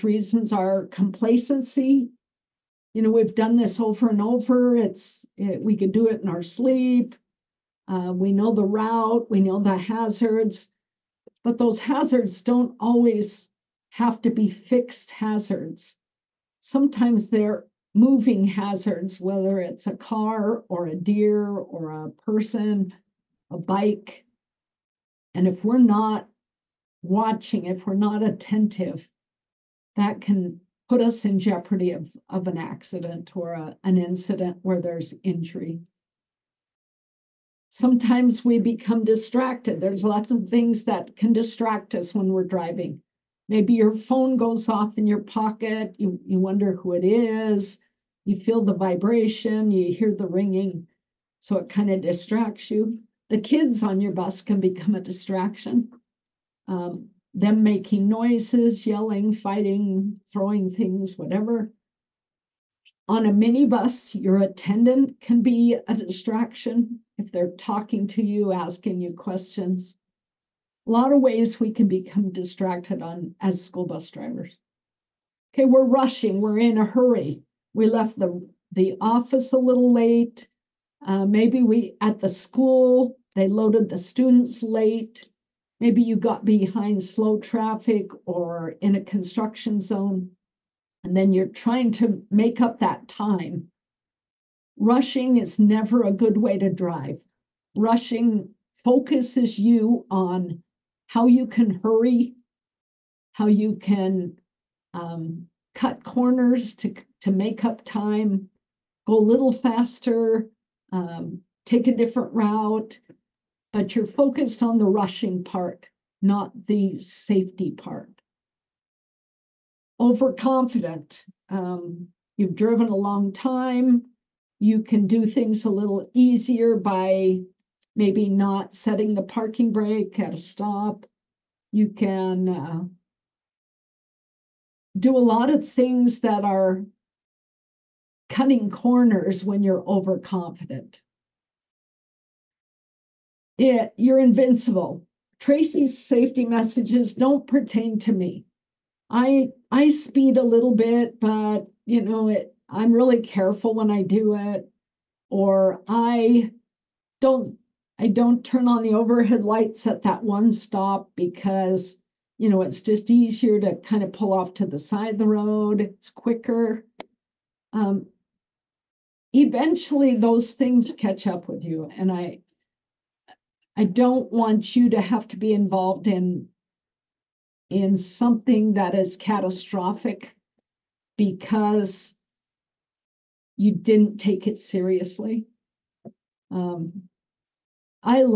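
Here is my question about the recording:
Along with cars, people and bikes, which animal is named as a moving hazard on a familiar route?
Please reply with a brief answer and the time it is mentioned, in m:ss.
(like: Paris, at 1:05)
deer, at 0:20.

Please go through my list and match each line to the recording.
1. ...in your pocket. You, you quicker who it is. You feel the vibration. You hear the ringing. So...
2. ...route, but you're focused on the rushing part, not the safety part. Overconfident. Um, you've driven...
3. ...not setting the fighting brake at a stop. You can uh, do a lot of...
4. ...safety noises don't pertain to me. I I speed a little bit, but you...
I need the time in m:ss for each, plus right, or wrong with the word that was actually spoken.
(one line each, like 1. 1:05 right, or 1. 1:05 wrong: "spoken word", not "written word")
1. 0:44 wrong: "wonder", not "quicker"
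2. 1:52 right
3. 2:08 wrong: "parking", not "fighting"
4. 2:26 wrong: "messages", not "noises".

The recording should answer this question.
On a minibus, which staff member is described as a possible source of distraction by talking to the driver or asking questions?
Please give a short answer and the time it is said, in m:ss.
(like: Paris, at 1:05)
attendant, at 1:04.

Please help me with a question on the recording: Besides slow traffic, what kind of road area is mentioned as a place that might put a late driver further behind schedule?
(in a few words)
construction zone.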